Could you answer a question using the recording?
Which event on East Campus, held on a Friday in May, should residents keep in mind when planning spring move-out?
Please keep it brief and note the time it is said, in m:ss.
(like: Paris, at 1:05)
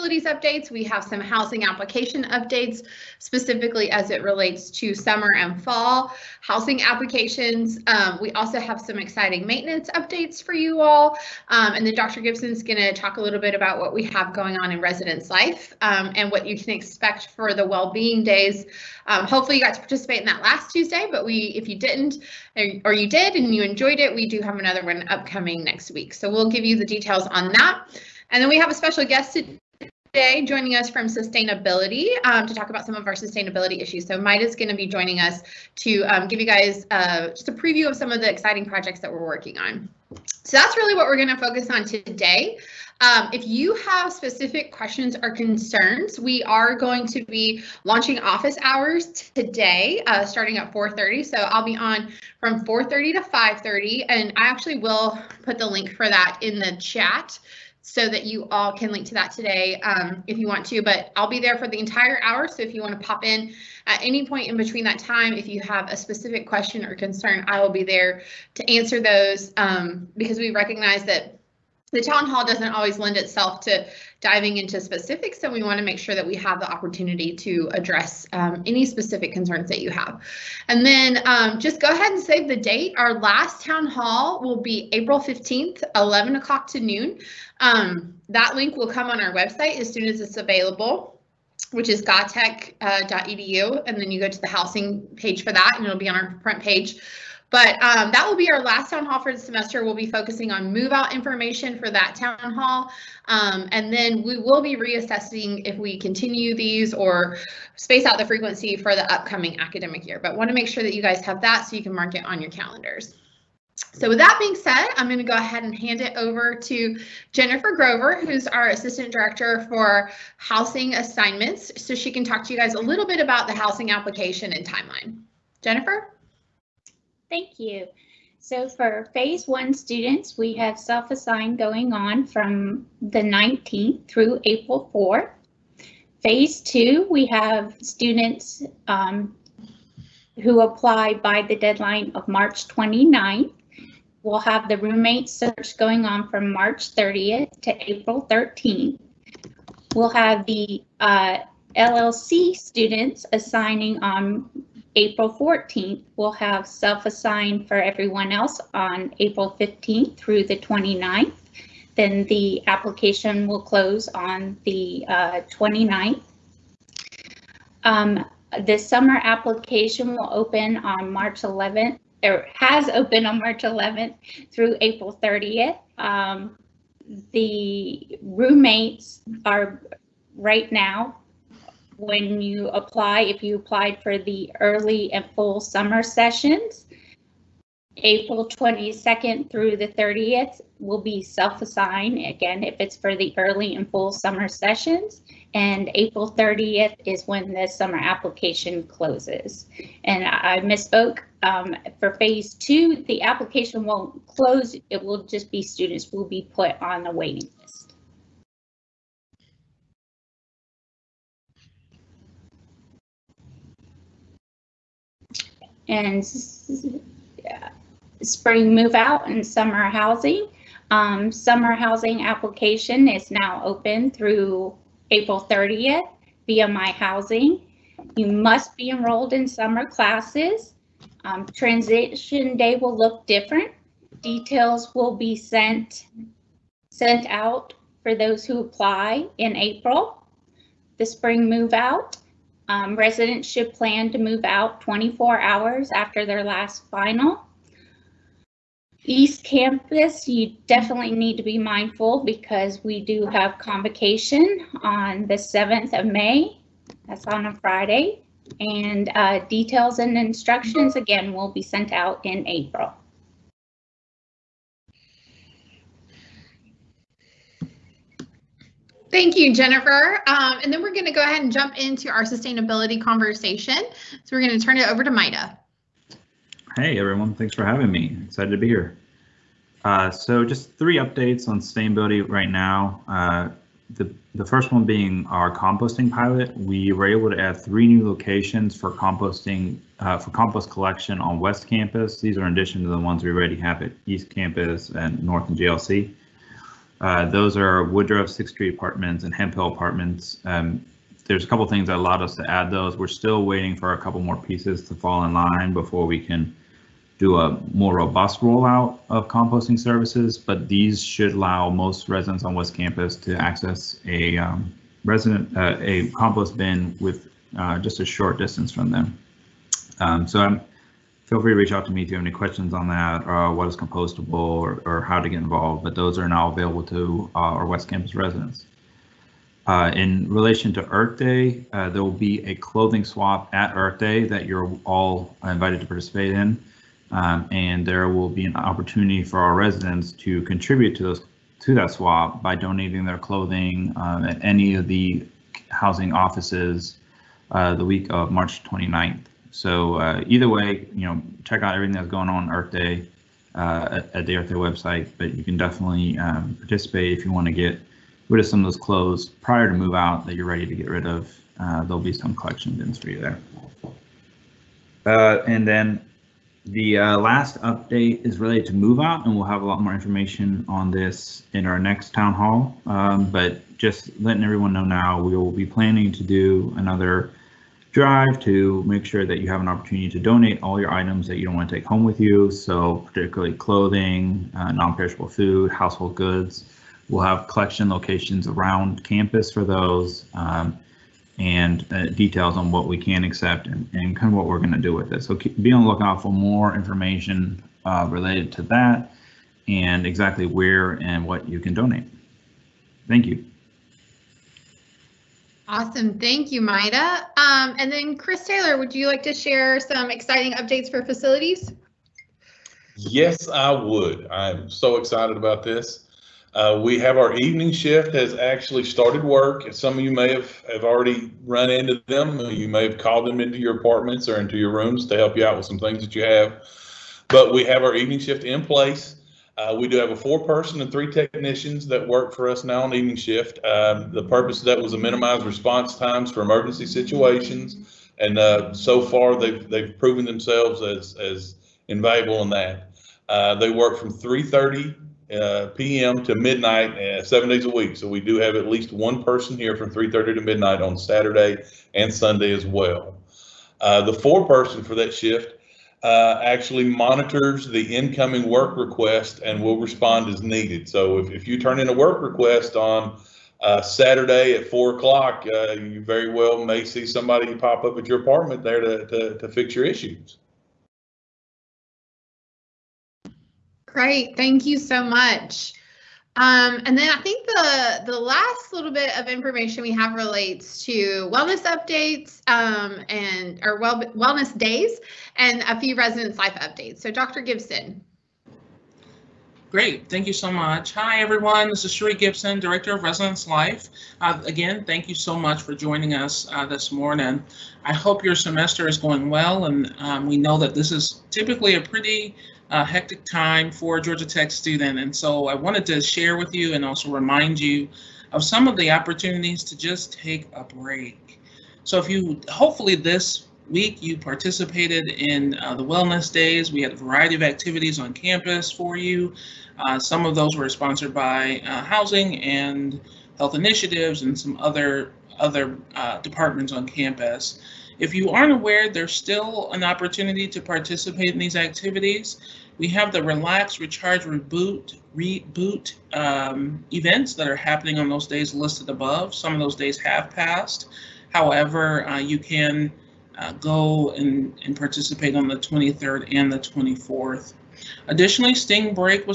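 Convocation, at 4:13.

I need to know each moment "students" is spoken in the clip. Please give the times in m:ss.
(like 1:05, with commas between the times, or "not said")
2:09, 2:17, 2:32, 3:25, 8:24.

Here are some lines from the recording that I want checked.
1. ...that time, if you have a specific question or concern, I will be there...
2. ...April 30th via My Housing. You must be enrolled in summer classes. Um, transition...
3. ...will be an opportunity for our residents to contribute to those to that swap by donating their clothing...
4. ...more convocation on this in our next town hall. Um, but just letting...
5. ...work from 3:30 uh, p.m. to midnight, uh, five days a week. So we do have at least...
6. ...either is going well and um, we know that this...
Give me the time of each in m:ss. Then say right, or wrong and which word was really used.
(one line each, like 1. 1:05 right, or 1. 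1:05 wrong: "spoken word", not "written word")
1. 1:04 right
2. 3:45 right
3. 5:38 right
4. 6:09 wrong: "information", not "convocation"
5. 7:23 wrong: "seven", not "five"
6. 8:18 wrong: "semester", not "either".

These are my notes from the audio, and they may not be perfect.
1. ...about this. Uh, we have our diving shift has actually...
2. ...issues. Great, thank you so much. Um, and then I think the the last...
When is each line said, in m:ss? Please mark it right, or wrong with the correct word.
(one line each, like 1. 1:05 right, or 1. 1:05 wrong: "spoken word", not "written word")
1. 6:55 wrong: "evening", not "diving"
2. 7:49 right.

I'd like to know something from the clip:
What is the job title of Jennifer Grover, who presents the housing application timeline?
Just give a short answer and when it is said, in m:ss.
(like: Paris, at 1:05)
Assistant Director for Housing Assignments, at 1:58.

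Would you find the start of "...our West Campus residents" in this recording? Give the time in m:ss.
5:27.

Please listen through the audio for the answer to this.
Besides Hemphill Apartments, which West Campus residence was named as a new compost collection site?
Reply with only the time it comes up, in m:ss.
4:57.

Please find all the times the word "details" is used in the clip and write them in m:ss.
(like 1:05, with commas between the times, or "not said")
0:26, 3:54, 4:19, 6:32.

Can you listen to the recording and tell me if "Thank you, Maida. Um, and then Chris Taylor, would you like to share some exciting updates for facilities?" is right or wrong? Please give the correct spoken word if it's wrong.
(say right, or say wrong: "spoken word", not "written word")
right.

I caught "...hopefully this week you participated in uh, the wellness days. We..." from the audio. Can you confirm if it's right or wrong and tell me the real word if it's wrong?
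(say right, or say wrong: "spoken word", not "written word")
right.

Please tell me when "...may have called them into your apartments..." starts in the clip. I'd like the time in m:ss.
7:02.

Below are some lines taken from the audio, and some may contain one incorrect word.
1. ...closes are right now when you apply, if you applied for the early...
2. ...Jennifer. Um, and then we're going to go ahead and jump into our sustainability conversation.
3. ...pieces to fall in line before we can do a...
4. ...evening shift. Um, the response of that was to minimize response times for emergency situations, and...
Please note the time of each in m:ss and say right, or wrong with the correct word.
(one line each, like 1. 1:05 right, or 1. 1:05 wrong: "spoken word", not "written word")
1. 2:58 wrong: "roommates", not "closes"
2. 4:29 right
3. 5:04 right
4. 7:12 wrong: "purpose", not "response".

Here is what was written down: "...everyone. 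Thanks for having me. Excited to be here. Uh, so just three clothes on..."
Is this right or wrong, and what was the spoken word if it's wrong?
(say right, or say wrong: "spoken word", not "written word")
wrong: "updates", not "clothes".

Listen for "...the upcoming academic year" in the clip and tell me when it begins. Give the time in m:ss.
1:48.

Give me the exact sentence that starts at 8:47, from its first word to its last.
If you aren't aware, there's still an opportunity to participate in these activities.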